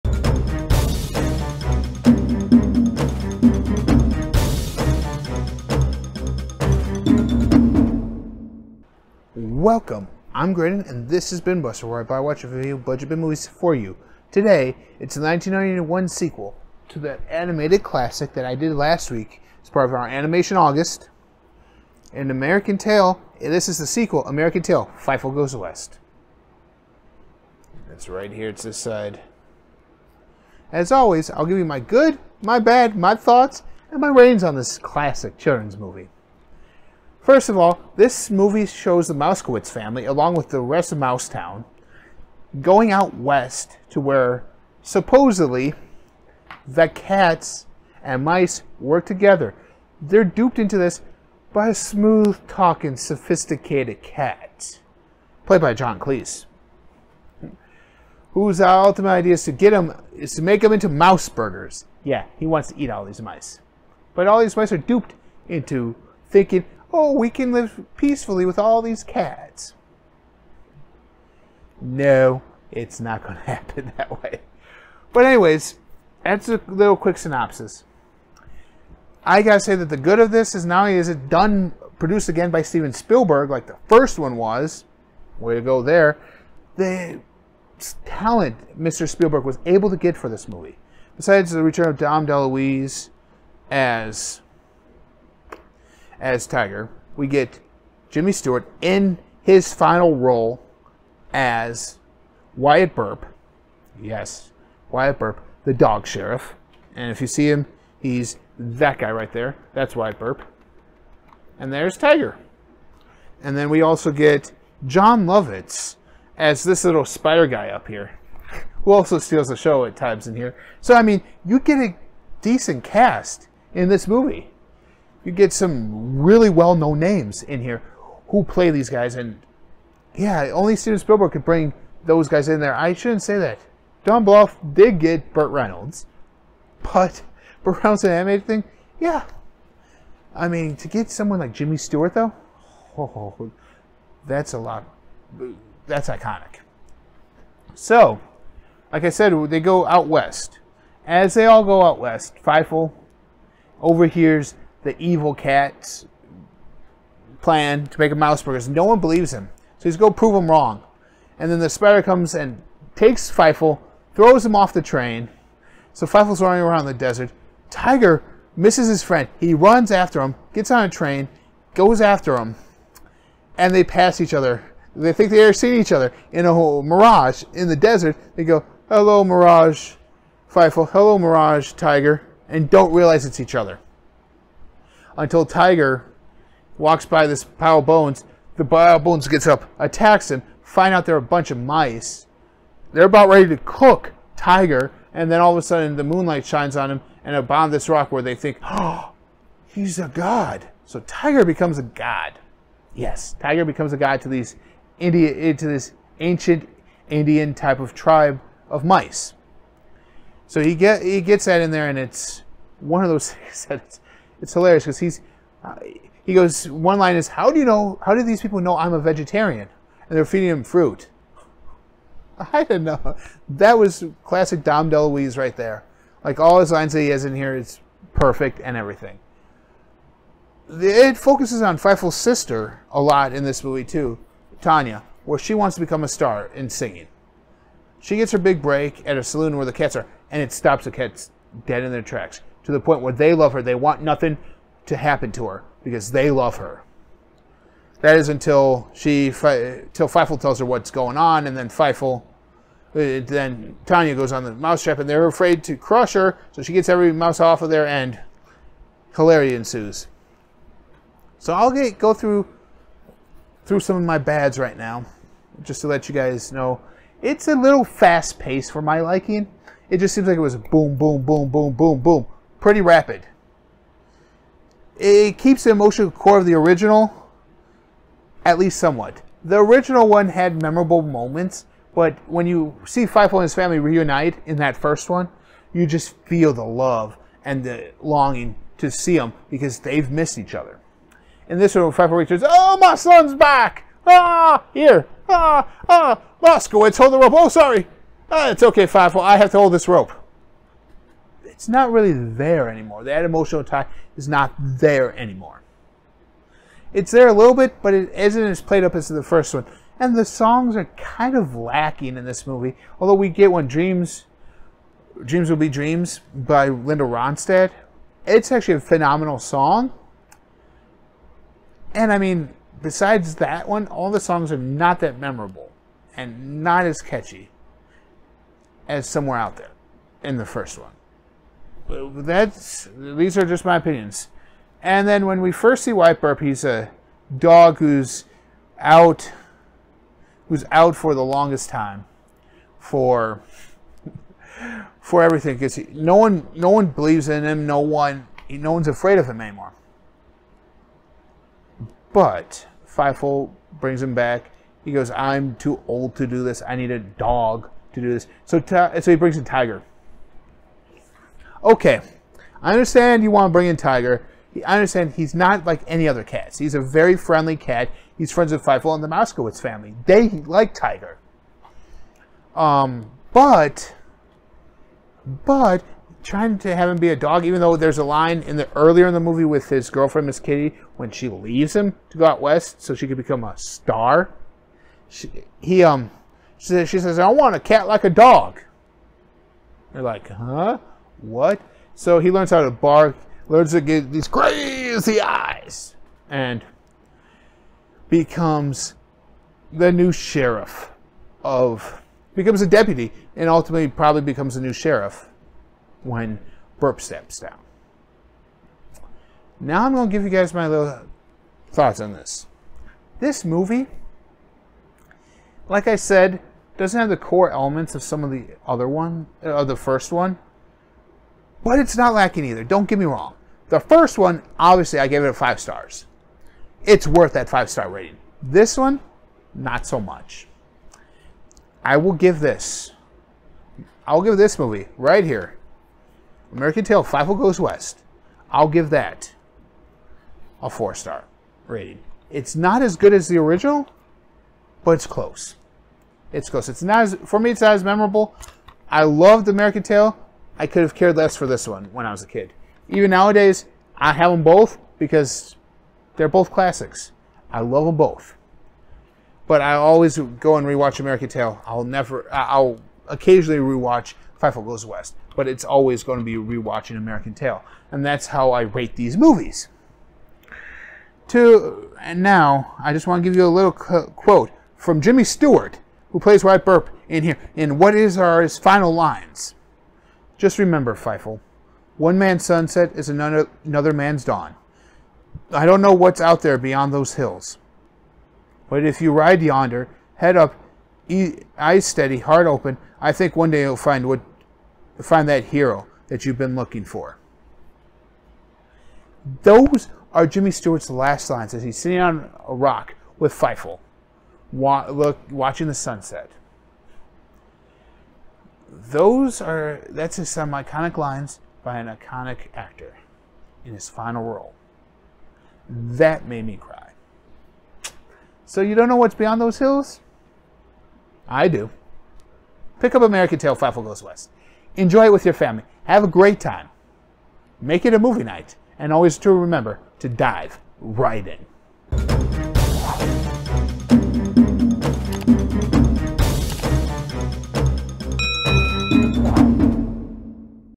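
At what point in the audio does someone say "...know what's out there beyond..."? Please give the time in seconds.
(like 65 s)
485 s.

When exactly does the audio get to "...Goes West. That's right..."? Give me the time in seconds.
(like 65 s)
25 s.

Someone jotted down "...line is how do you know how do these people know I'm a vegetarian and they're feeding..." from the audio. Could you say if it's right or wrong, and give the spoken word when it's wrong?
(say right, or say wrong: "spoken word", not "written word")
right.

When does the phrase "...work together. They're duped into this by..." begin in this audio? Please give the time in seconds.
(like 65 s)
48 s.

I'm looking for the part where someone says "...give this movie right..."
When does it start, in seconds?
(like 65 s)
434 s.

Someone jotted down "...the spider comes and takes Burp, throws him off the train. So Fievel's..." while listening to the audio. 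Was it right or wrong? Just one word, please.
wrong.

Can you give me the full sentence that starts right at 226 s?
Like all his lines that he has in here is perfect and everything.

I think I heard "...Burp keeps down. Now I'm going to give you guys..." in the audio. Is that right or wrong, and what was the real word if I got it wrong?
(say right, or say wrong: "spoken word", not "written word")
wrong: "steps", not "keeps".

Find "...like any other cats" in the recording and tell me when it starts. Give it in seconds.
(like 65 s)
365 s.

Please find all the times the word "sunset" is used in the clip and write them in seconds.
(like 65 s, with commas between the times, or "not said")
482 s, 505 s.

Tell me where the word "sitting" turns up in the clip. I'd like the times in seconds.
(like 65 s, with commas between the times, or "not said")
501 s.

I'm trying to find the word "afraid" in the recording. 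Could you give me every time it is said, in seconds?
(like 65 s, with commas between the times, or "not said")
255 s, 348 s.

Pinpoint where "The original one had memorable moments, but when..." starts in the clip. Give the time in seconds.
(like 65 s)
279 s.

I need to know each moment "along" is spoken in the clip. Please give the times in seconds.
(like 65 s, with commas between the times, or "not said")
40 s.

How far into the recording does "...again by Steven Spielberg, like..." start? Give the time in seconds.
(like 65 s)
82 s.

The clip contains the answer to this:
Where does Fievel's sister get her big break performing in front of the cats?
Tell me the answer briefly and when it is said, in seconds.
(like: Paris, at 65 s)
A saloon, at 239 s.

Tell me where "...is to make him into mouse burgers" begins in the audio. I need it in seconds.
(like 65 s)
60 s.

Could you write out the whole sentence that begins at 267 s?
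It's a little fast paced for my liking.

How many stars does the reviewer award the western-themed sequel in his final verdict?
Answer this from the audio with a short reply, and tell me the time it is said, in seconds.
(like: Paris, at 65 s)
4, at 440 s.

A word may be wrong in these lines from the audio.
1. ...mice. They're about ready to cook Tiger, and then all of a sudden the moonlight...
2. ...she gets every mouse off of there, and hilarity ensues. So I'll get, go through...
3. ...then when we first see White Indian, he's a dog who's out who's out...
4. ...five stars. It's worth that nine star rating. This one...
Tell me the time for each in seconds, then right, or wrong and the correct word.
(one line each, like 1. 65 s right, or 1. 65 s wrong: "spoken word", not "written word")
1. 191 s right
2. 256 s right
3. 335 s wrong: "Burp", not "Indian"
4. 425 s wrong: "five", not "nine".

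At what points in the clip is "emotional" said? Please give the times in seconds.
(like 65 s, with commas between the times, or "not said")
275 s, 303 s.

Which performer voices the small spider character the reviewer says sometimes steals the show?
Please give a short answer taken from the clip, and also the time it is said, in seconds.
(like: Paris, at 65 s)
Jon Lovitz, at 114 s.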